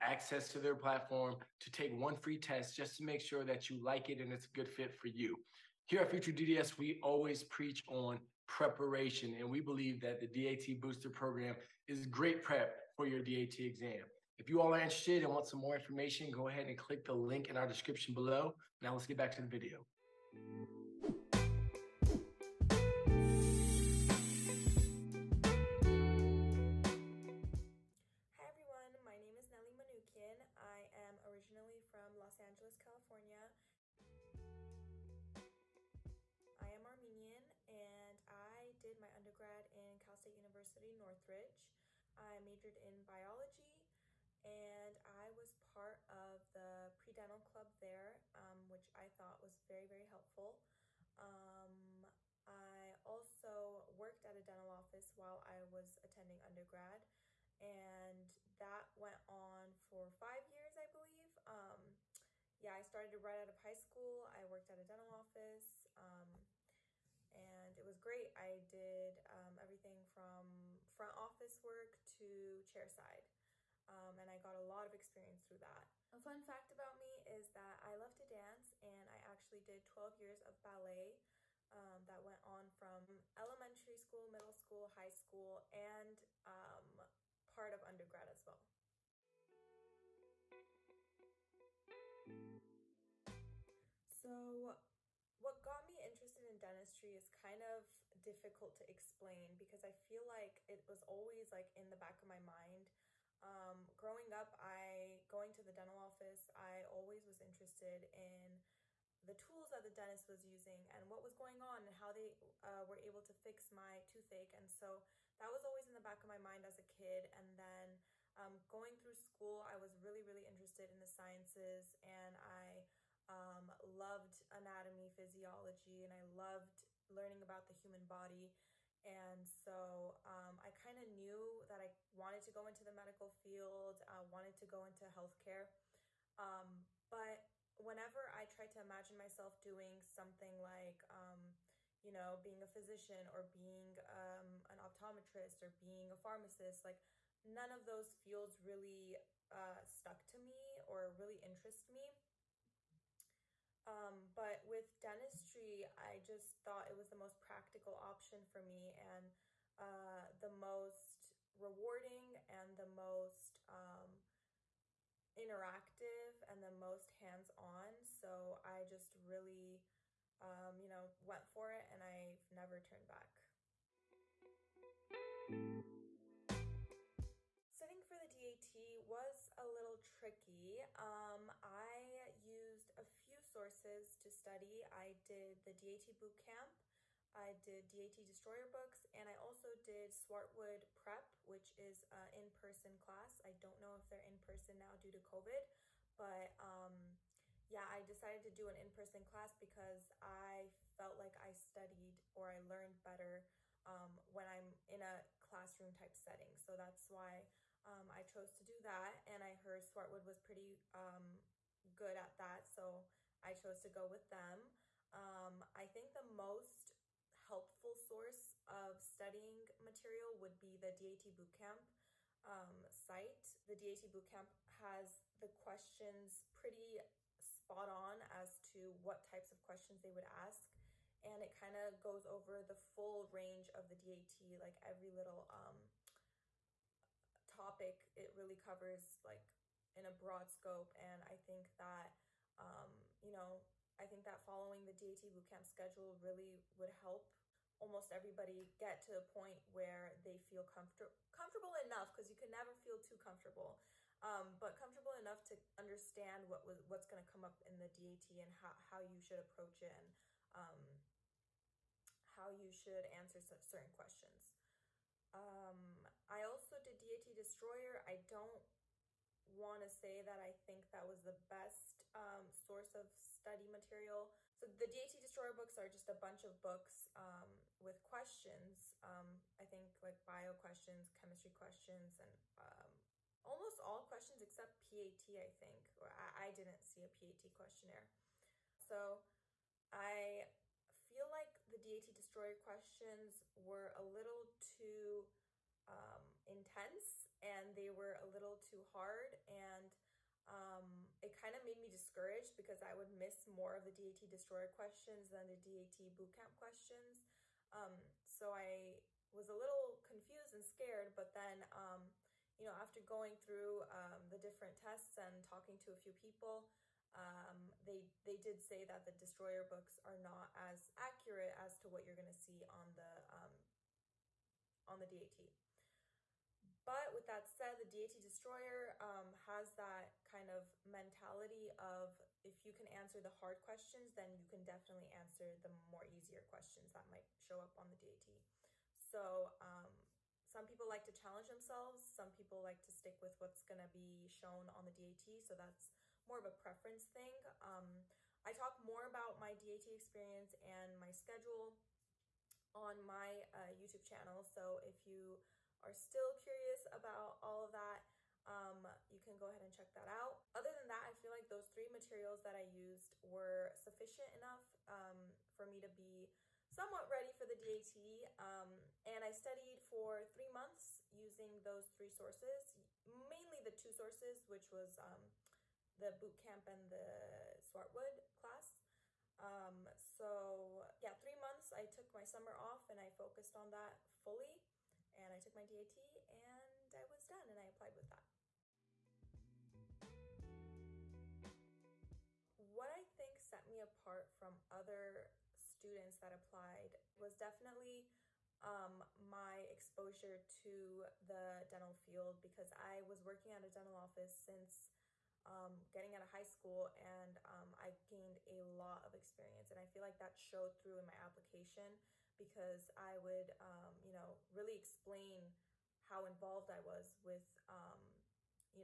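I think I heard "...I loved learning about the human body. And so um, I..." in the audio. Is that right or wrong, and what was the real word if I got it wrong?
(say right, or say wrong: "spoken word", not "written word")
right.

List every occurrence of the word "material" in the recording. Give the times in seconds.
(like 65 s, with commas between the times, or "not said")
219 s, 273 s, 361 s.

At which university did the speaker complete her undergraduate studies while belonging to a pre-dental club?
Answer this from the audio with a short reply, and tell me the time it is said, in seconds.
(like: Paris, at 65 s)
Cal State University Northridge, at 39 s.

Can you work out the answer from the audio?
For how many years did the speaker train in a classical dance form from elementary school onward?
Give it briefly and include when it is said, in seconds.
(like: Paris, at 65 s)
12, at 79 s.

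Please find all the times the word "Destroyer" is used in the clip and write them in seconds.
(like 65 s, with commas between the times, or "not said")
188 s, 267 s, 275 s, 292 s, 304 s, 319 s, 328 s.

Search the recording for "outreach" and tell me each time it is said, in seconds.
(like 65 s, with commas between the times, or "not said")
not said.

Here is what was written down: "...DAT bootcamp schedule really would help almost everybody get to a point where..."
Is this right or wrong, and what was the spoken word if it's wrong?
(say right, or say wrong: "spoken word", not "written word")
right.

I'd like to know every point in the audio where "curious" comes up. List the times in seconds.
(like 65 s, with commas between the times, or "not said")
356 s.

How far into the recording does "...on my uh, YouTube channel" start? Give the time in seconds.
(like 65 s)
352 s.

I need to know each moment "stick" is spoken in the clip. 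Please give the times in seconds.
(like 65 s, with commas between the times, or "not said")
342 s.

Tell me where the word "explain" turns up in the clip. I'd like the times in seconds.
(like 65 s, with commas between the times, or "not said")
98 s, 414 s.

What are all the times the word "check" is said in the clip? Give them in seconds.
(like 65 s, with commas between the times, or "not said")
359 s.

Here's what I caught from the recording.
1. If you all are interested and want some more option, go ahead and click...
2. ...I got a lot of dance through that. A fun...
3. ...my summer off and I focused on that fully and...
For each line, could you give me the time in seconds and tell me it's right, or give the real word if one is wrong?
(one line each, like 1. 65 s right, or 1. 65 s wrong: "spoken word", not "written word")
1. 14 s wrong: "information", not "option"
2. 74 s wrong: "experience", not "dance"
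3. 382 s right.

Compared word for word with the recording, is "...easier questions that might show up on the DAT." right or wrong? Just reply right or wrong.
right.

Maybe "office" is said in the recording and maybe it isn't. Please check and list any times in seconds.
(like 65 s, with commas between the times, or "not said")
54 s, 65 s, 71 s, 105 s, 403 s.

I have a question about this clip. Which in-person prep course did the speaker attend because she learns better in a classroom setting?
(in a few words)
Swartwood Prep.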